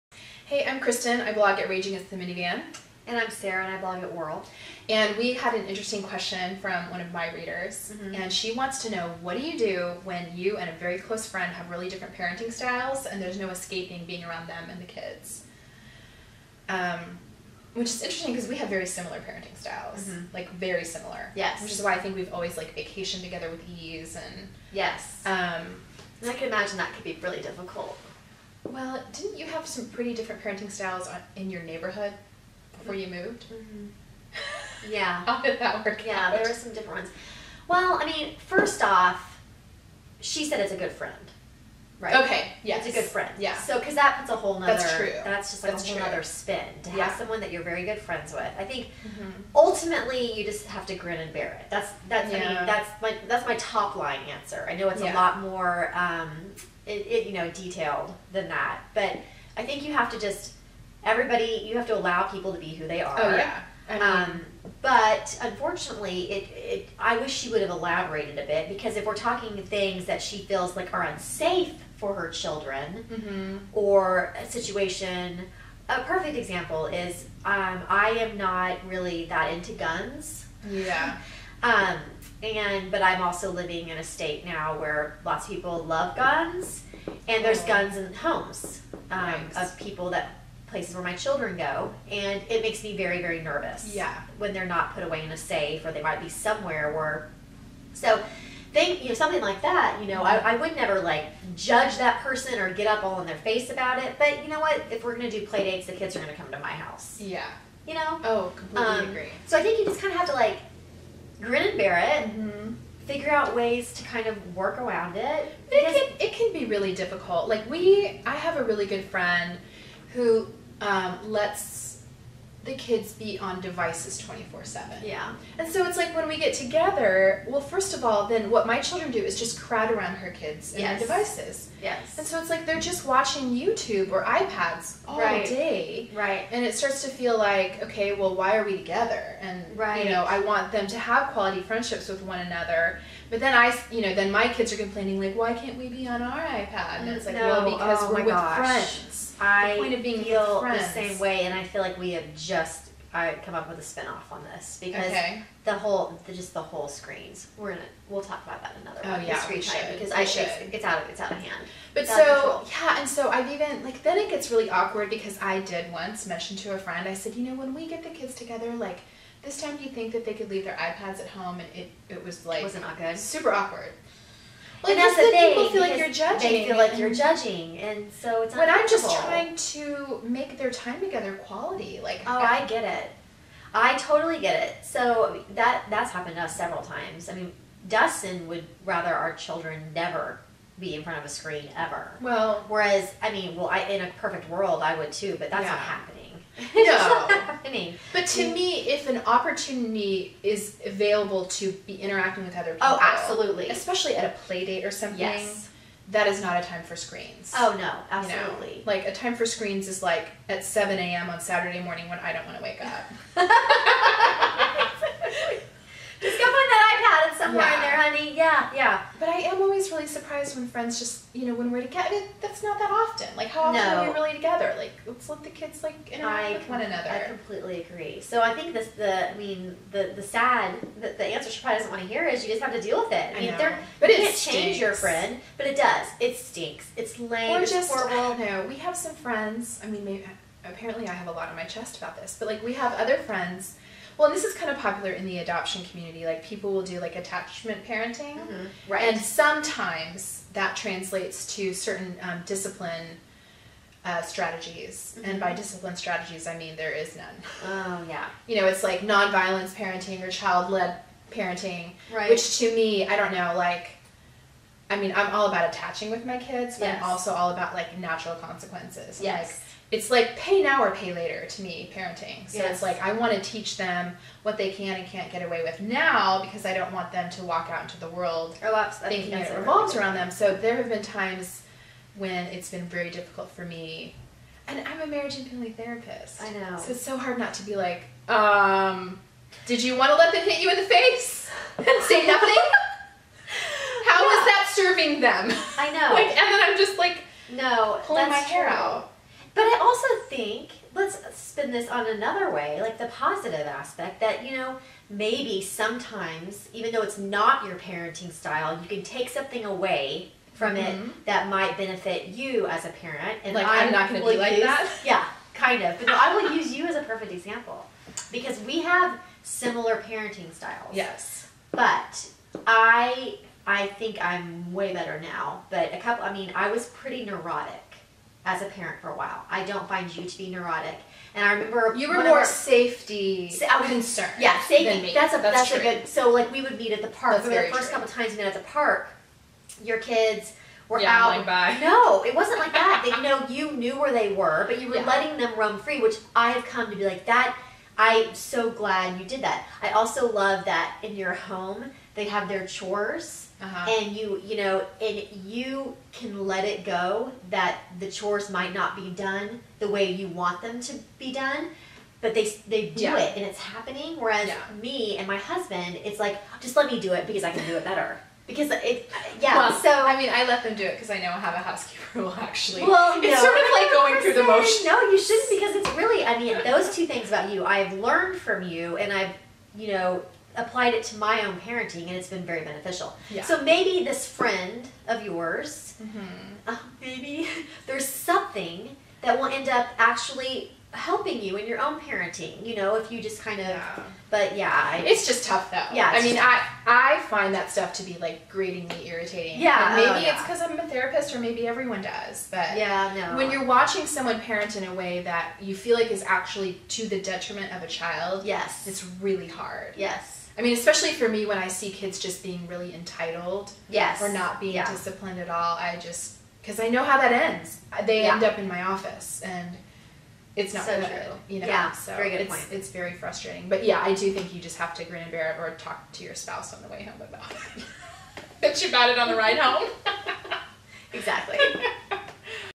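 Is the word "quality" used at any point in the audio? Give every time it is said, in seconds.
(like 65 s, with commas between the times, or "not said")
141 s, 181 s.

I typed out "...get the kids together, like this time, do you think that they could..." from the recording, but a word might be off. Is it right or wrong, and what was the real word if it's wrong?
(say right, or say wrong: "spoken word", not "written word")
right.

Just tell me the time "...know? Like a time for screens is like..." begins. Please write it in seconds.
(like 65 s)
208 s.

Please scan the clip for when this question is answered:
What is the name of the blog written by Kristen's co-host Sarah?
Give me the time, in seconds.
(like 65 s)
4 s.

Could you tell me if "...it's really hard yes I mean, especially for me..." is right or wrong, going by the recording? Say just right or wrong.
right.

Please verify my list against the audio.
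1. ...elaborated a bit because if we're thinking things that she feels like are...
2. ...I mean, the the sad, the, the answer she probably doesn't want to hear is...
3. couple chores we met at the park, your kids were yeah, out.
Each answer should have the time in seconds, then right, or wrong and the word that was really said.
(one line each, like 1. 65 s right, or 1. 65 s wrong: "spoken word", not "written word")
1. 67 s wrong: "talking", not "thinking"
2. 229 s right
3. 337 s wrong: "times", not "chores".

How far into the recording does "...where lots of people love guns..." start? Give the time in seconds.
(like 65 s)
84 s.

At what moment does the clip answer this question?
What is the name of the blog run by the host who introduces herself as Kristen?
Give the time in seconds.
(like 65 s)
1 s.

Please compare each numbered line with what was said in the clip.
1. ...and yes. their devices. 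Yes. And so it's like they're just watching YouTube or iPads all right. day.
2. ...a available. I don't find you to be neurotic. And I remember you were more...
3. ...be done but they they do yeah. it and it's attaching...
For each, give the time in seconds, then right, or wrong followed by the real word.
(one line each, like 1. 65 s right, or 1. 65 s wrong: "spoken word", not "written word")
1. 130 s right
2. 329 s wrong: "while", not "available"
3. 361 s wrong: "happening", not "attaching".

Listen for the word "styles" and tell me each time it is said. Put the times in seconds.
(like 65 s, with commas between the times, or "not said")
12 s, 19 s, 30 s, 308 s, 320 s.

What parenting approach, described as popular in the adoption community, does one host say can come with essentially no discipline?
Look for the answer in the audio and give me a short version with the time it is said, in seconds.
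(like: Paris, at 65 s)
Attachment parenting, at 247 s.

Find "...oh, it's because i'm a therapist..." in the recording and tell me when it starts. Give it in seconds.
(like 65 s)
400 s.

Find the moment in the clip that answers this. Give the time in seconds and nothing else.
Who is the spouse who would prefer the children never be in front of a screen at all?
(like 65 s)
187 s.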